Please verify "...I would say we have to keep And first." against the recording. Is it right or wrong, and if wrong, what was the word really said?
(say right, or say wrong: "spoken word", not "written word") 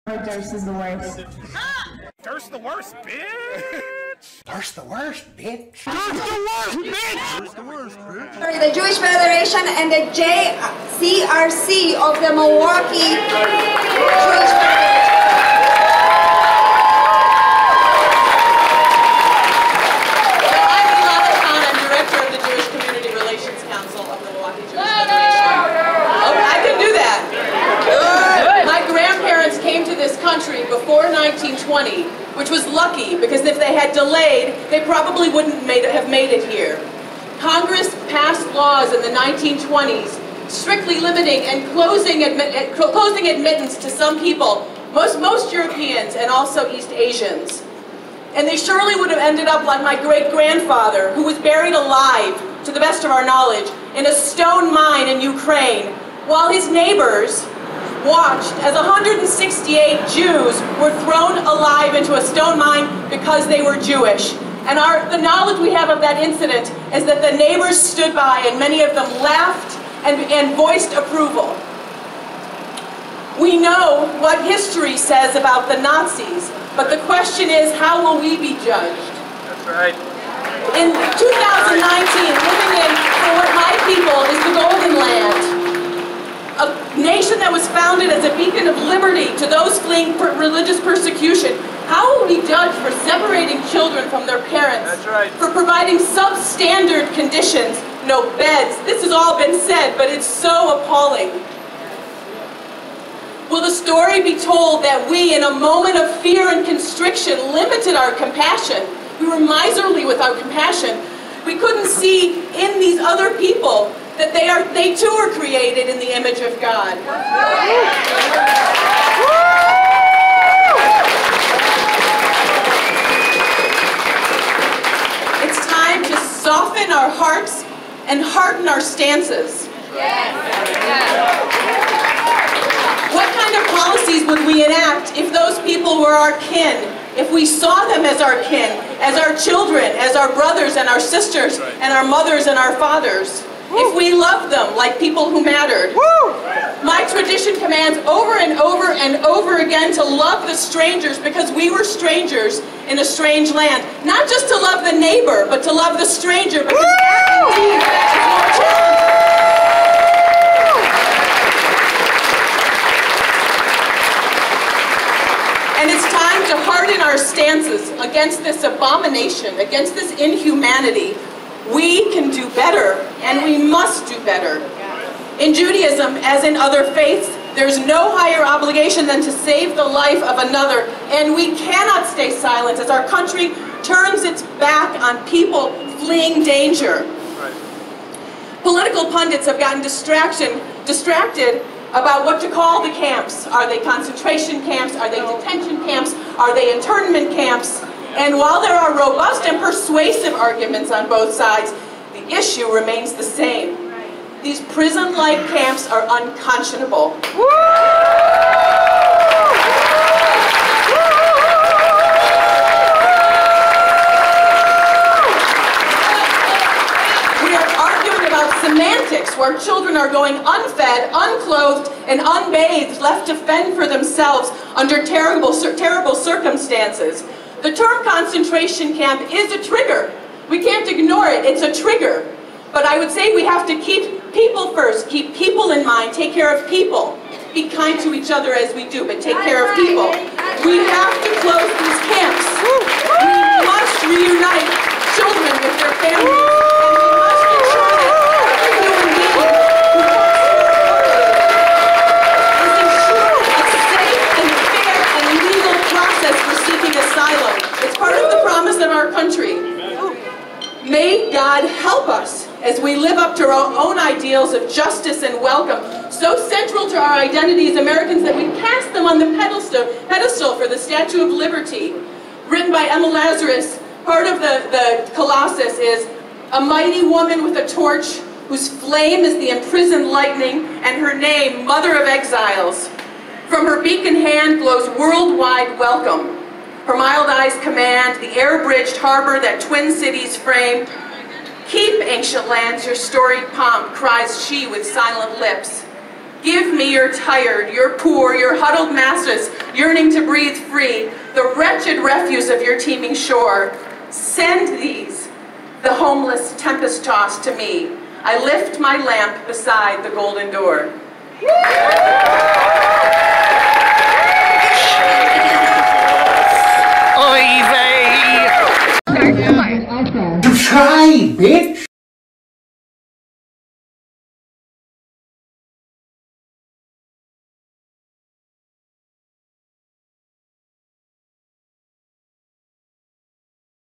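wrong: "People", not "And".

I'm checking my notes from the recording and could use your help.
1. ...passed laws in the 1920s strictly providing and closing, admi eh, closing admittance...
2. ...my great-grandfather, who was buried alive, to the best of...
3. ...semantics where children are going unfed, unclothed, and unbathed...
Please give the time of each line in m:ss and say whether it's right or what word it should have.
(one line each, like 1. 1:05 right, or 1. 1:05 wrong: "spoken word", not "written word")
1. 0:38 wrong: "limiting", not "providing"
2. 0:49 right
3. 3:38 right.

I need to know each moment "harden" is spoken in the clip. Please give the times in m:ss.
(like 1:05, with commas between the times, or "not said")
2:08, 2:46.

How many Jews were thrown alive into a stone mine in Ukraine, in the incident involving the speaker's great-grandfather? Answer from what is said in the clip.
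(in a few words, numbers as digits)
168.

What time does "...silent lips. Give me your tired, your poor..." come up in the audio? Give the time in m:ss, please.
4:54.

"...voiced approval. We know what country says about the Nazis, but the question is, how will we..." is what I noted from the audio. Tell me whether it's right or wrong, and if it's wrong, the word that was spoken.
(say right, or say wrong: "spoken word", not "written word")
wrong: "history", not "country".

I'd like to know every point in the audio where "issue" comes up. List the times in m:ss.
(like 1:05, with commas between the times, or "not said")
3:22.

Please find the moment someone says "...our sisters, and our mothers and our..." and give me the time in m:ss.
2:20.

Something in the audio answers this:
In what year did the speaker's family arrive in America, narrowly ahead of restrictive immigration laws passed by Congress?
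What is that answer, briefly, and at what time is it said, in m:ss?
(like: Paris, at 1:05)
1920, at 0:31.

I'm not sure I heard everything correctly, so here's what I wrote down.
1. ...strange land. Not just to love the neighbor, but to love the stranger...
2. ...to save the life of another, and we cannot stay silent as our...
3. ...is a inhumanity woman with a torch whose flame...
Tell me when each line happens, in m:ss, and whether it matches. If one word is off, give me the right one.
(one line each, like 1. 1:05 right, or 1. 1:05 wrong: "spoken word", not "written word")
1. 2:33 right
2. 2:59 right
3. 4:35 wrong: "mighty", not "inhumanity".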